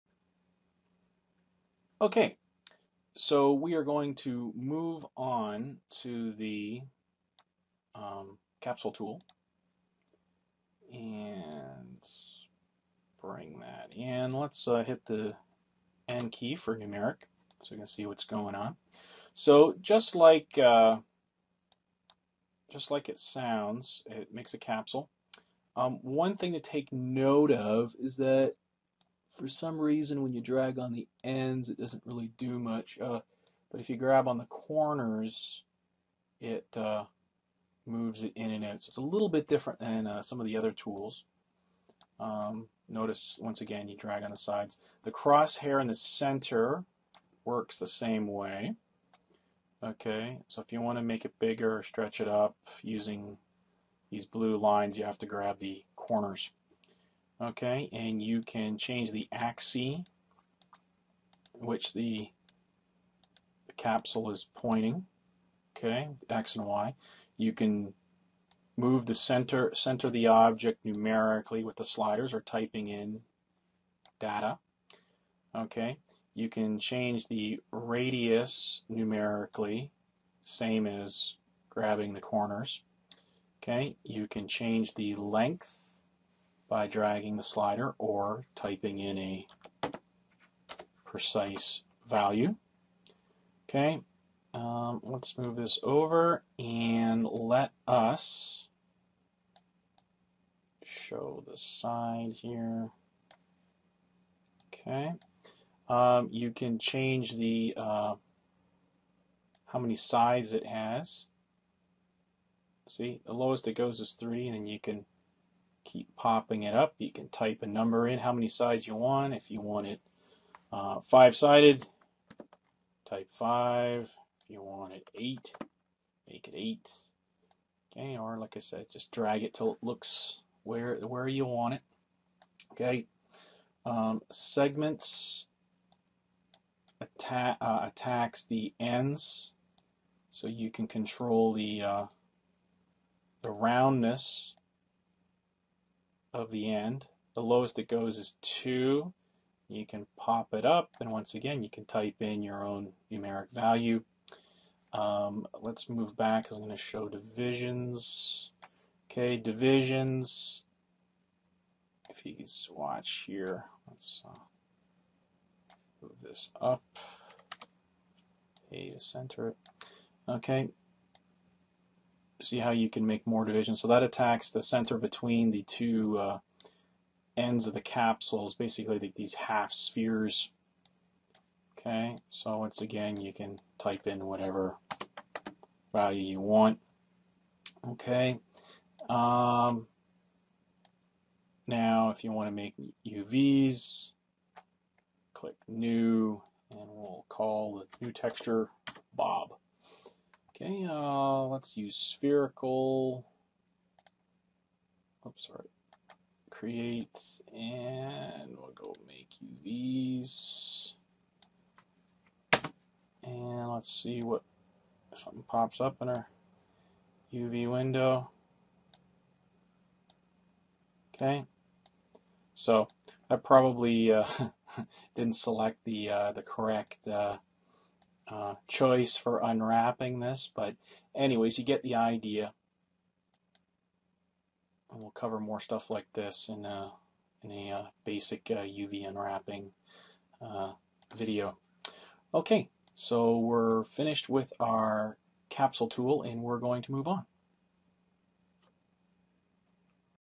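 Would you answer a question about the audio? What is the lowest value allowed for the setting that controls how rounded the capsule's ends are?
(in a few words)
2.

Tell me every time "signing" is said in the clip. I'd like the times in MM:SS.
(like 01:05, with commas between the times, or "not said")
not said.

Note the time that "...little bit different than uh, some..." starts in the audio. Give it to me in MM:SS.
00:39.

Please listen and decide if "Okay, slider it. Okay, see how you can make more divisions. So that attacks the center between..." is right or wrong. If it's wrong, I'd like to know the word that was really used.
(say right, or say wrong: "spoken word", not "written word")
wrong: "center", not "slider".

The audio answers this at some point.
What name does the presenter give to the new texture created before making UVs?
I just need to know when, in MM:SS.
03:19.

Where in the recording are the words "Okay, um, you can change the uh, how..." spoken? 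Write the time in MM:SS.
01:44.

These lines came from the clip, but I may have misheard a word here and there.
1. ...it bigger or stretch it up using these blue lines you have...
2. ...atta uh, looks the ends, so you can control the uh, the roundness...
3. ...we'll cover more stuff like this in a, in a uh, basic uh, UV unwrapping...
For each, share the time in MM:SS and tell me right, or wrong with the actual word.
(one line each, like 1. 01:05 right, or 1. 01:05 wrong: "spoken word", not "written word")
1. 00:51 right
2. 02:17 wrong: "attacks", not "looks"
3. 03:55 right.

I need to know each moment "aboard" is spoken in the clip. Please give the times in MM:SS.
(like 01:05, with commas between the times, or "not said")
not said.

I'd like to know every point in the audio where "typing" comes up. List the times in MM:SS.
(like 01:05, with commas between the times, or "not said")
01:12, 01:28.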